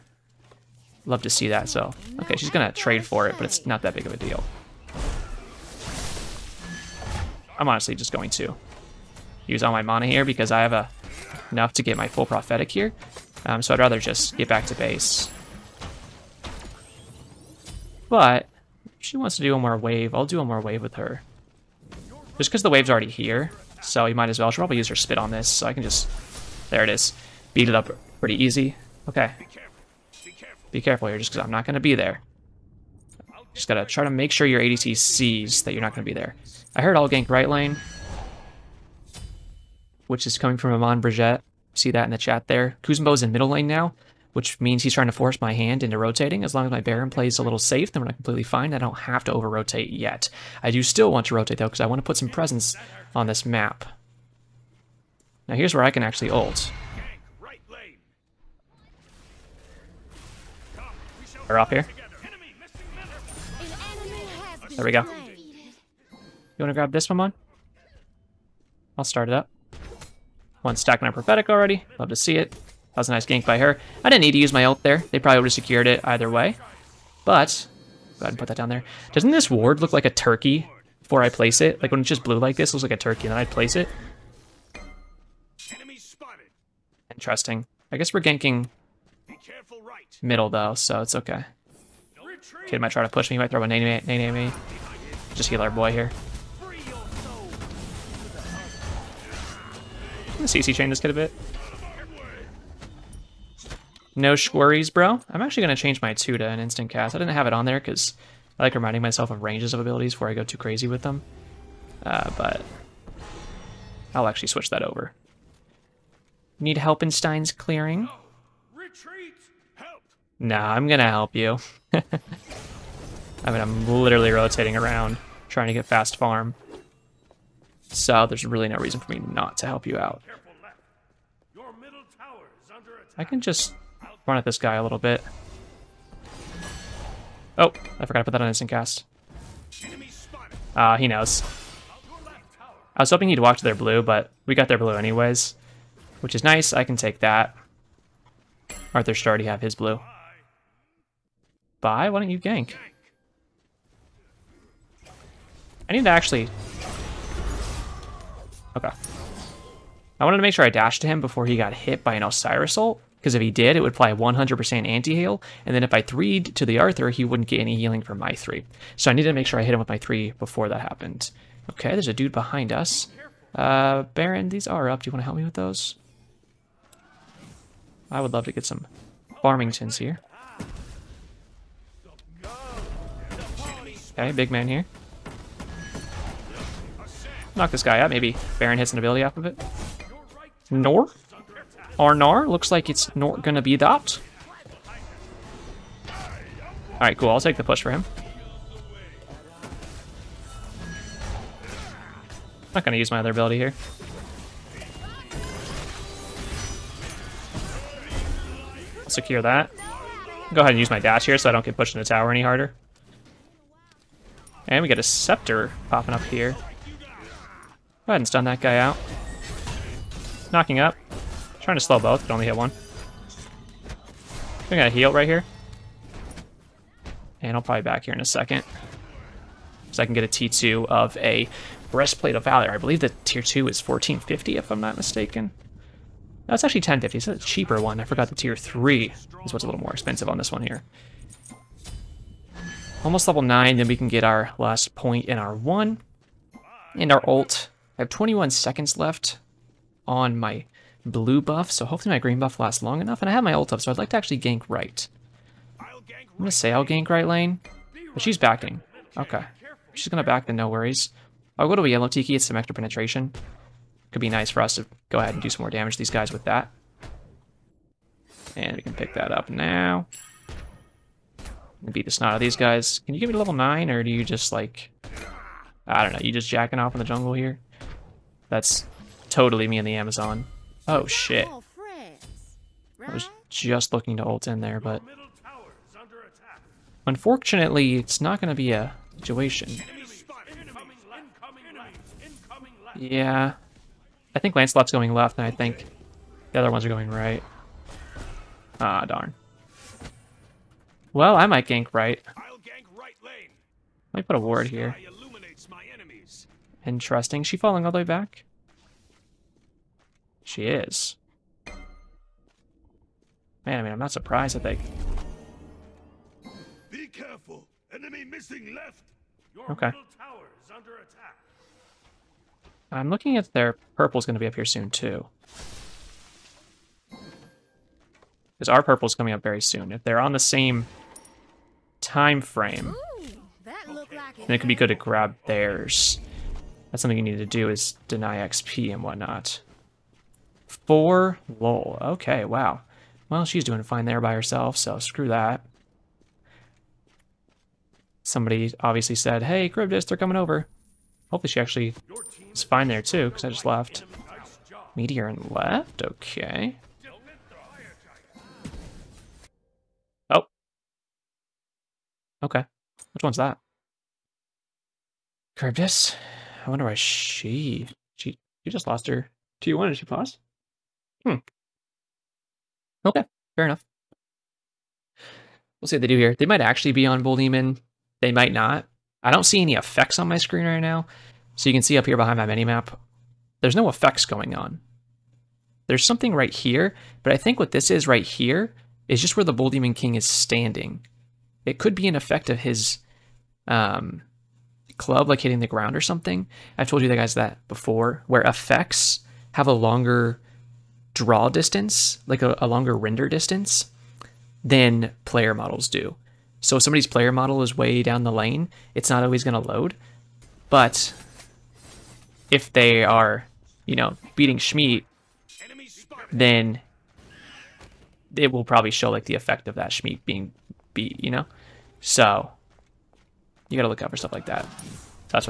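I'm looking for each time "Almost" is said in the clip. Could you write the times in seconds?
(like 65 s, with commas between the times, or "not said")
243 s.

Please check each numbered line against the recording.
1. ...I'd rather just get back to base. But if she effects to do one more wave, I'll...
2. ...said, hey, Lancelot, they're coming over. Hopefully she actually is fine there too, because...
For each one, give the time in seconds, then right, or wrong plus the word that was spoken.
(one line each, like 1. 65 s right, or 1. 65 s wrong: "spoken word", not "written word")
1. 13 s wrong: "wants", not "effects"
2. 349 s wrong: "Charybdis", not "Lancelot".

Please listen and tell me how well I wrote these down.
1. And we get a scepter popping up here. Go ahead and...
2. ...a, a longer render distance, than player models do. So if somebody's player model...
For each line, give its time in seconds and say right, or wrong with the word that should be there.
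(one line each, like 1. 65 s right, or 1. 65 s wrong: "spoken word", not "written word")
1. 214 s right
2. 402 s right.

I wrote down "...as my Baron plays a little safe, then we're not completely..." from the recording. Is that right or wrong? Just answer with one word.
right.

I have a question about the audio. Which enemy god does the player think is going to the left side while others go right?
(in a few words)
Lancelot.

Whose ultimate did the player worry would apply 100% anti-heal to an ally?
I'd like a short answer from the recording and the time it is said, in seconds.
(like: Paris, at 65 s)
Osiris, at 162 s.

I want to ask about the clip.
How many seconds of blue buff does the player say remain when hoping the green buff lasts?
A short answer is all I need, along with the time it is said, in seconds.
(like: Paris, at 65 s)
21, at 248 s.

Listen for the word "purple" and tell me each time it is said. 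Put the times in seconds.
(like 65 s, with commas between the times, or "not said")
323 s, 328 s.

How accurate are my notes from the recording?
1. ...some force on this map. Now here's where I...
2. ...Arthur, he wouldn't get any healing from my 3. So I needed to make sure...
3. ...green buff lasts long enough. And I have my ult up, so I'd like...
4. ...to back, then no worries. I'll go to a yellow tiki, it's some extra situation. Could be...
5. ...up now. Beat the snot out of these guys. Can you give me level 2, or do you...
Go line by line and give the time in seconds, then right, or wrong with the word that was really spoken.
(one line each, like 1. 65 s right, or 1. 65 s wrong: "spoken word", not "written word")
1. 52 s wrong: "presence", not "force"
2. 166 s right
3. 252 s right
4. 260 s wrong: "penetration", not "situation"
5. 269 s wrong: "9", not "2".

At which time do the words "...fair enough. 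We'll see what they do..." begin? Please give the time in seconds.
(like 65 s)
373 s.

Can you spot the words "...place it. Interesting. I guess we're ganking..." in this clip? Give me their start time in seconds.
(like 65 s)
83 s.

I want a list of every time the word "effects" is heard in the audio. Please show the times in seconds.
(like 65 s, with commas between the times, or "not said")
379 s, 383 s, 392 s, 398 s, 419 s.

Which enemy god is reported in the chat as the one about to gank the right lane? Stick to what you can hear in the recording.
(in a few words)
Maman Brigitte.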